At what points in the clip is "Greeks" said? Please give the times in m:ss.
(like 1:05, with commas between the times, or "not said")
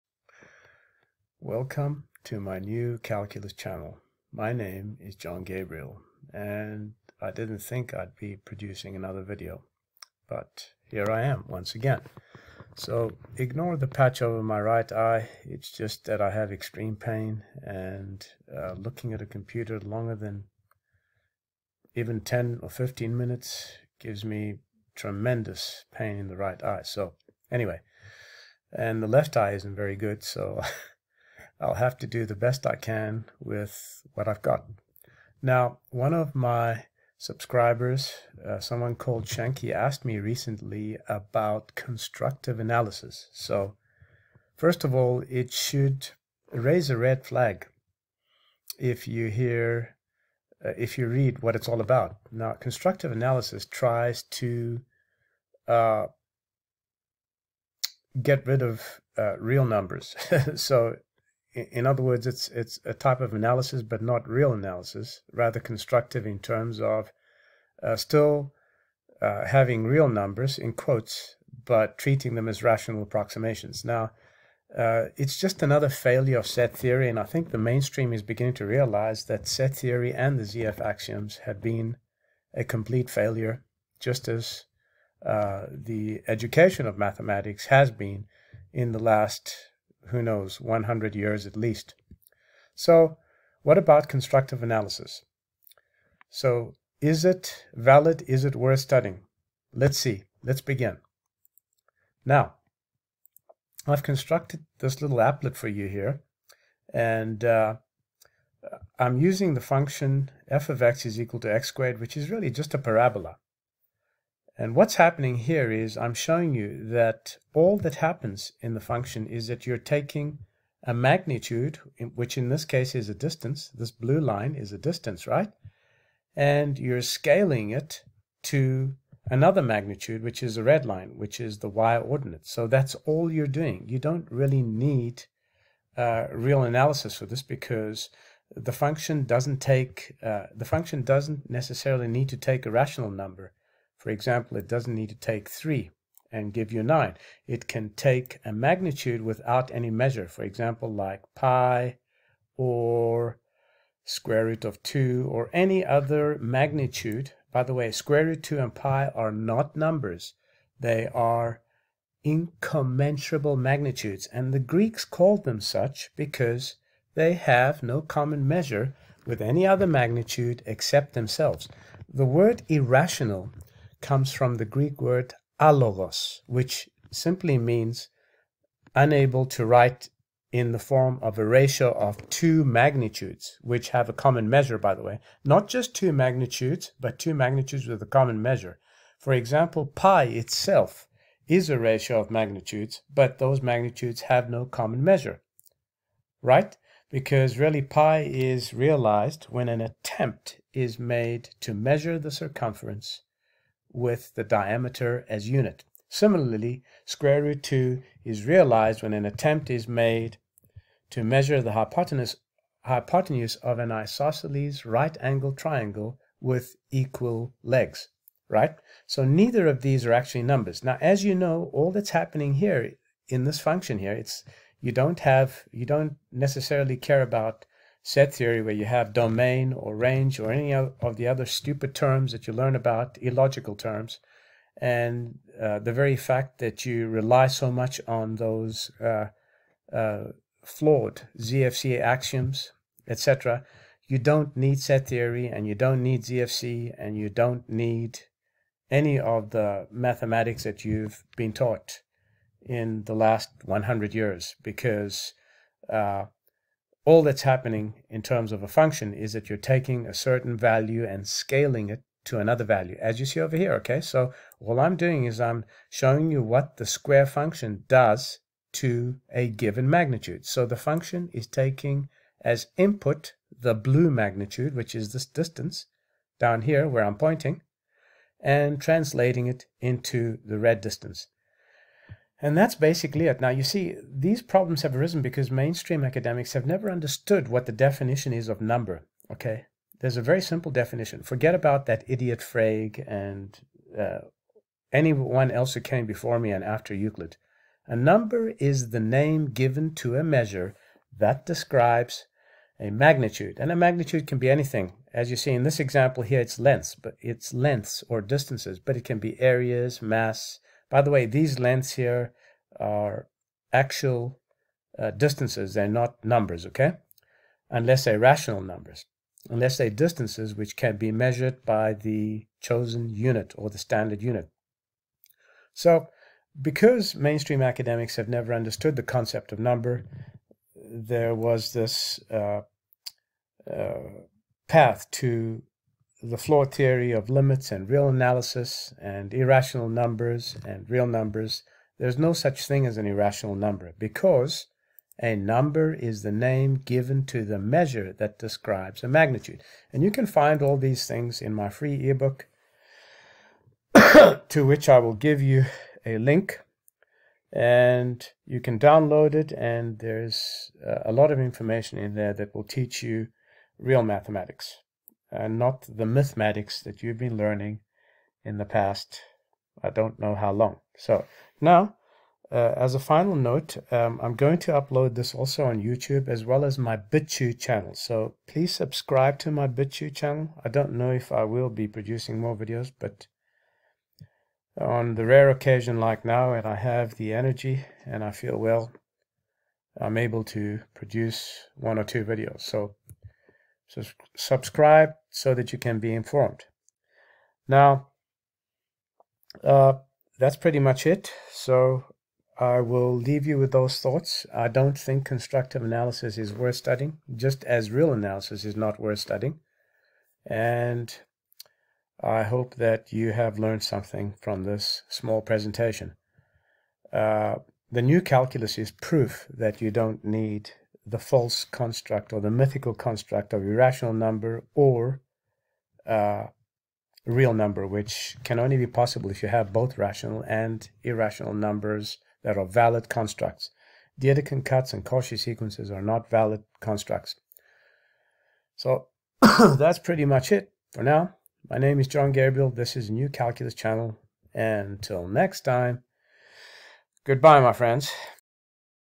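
2:44, 2:54.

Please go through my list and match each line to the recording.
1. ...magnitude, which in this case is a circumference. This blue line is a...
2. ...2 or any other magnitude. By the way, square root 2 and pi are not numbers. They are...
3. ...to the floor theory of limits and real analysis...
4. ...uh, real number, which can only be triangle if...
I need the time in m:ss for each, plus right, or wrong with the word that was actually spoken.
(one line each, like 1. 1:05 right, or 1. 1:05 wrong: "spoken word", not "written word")
1. 2:00 wrong: "distance", not "circumference"
2. 2:34 right
3. 5:35 right
4. 7:06 wrong: "possible", not "triangle".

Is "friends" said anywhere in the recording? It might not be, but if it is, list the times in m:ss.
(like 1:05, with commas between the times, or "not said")
7:27.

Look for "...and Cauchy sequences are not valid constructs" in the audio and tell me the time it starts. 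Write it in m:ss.
7:14.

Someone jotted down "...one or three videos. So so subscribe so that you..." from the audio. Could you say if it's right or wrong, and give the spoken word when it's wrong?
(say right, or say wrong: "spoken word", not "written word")
wrong: "two", not "three".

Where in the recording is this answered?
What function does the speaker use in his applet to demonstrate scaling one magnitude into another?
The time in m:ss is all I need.
1:51.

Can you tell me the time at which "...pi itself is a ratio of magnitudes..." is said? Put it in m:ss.
3:09.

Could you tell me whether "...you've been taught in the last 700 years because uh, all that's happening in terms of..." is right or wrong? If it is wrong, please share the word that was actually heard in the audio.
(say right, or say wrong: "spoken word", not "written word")
wrong: "100", not "700".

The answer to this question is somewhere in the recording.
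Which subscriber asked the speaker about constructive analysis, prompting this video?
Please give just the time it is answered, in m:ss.
0:39.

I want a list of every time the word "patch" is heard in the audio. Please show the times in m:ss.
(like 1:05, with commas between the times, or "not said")
0:13.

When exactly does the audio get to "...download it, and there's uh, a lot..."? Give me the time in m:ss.
5:58.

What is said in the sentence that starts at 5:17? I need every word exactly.
Unless they're rational numbers, unless they're distances which can be measured by the chosen unit or the standard unit.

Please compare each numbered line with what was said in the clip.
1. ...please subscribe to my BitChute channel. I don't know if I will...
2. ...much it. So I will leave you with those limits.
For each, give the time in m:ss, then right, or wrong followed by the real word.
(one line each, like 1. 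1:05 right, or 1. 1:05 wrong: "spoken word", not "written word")
1. 6:18 right
2. 6:40 wrong: "thoughts", not "limits".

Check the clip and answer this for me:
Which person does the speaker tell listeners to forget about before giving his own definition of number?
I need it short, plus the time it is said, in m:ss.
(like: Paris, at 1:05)
Frege, at 4:52.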